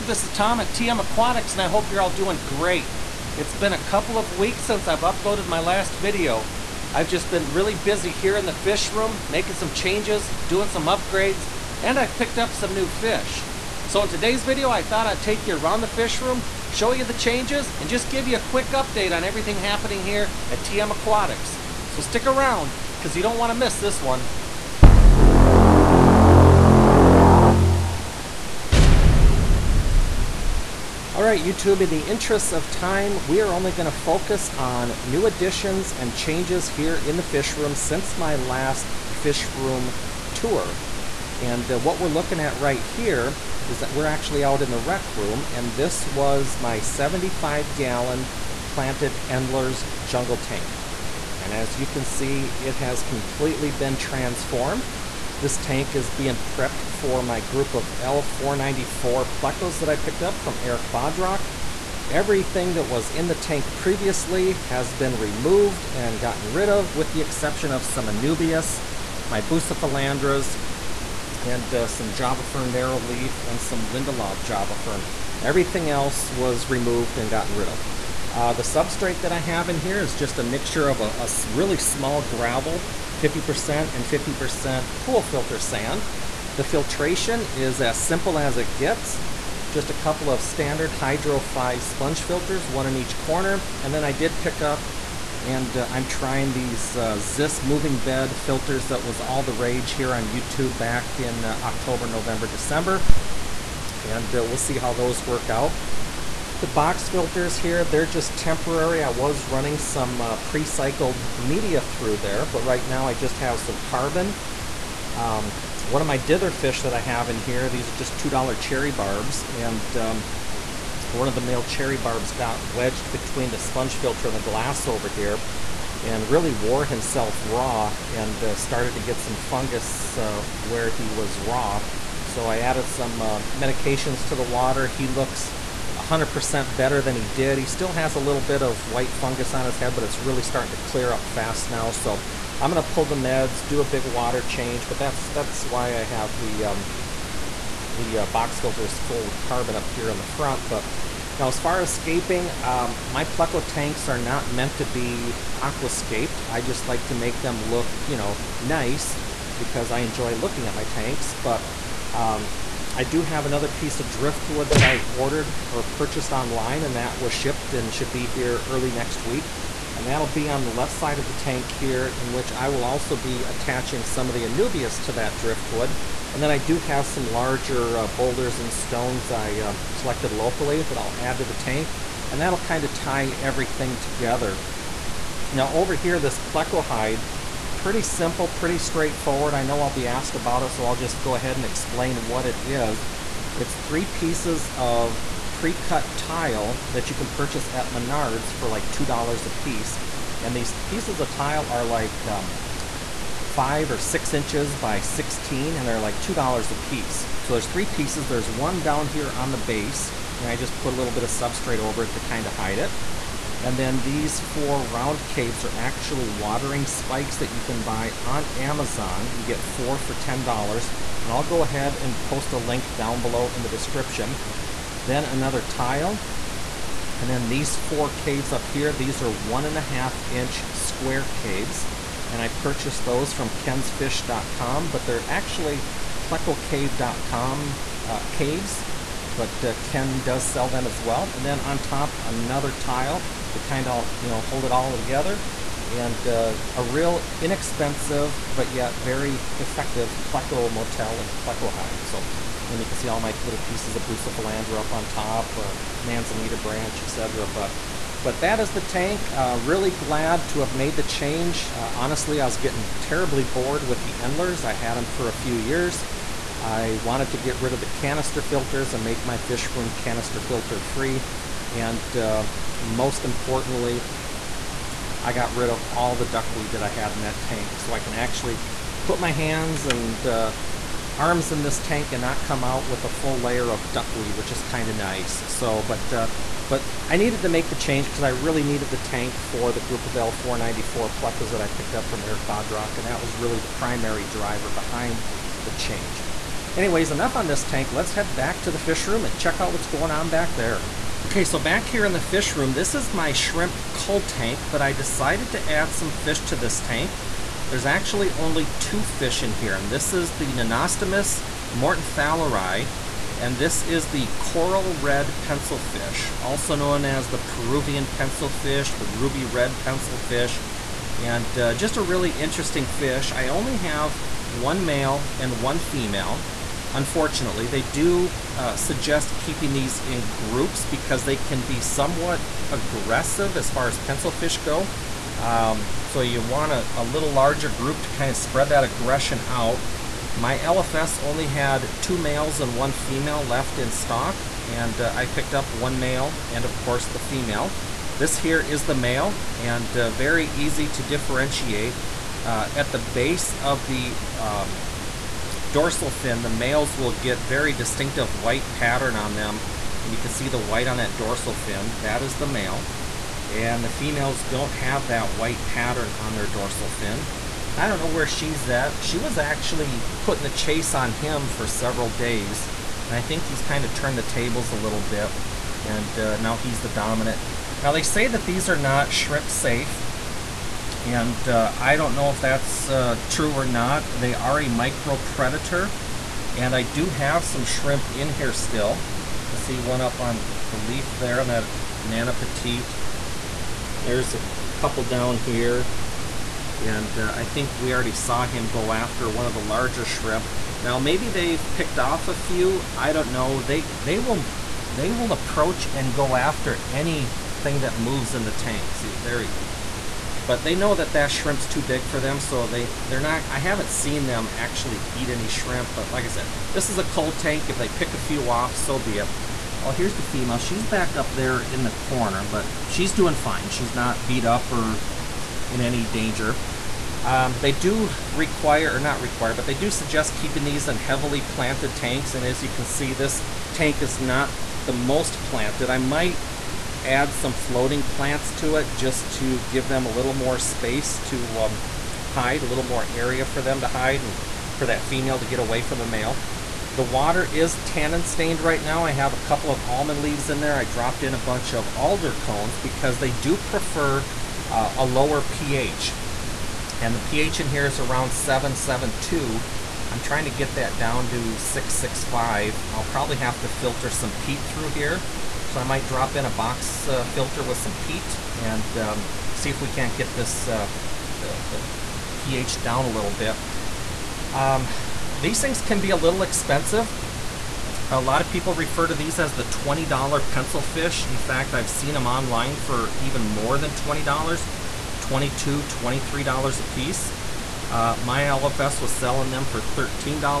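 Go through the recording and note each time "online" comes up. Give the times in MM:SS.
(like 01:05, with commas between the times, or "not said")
02:46, 08:02.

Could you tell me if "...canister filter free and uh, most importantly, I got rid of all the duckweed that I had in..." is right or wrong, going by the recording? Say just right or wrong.
right.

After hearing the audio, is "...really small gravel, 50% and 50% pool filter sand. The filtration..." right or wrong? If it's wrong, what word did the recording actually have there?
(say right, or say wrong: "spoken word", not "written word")
right.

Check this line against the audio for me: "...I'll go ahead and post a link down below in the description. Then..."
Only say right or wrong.
right.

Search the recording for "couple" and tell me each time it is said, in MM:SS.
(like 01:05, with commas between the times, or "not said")
00:03, 01:29, 06:34, 07:29.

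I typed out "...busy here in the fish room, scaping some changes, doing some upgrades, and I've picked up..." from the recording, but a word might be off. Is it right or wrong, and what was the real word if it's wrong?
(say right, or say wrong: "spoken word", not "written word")
wrong: "making", not "scaping".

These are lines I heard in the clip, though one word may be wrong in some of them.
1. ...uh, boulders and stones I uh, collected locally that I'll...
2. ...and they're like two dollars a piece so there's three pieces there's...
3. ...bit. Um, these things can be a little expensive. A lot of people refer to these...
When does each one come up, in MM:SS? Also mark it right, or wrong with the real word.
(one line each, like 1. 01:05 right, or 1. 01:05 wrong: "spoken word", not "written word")
1. 02:57 right
2. 03:25 right
3. 07:53 right.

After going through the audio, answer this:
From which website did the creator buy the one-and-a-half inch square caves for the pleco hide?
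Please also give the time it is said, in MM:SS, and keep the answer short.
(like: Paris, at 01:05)
kensfish.com, at 03:53.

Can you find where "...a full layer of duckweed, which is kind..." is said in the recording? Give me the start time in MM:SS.
04:43.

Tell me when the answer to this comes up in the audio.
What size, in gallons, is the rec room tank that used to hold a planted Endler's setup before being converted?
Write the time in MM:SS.
00:46.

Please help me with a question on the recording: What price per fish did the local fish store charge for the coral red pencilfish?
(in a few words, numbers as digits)
$13.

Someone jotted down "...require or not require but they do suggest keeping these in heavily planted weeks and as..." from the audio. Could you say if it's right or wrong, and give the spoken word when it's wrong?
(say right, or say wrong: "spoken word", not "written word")
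wrong: "tanks", not "weeks".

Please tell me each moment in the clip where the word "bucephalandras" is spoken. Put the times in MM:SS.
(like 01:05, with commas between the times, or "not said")
01:09, 04:14.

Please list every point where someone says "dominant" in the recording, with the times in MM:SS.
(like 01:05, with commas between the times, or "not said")
06:16.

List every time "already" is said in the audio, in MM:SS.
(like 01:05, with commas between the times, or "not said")
06:37.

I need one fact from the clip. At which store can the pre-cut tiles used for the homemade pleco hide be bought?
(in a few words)
Menards.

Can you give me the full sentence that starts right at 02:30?
But now as far as scaping, um, my Pleco tanks are not meant to be aquascaped.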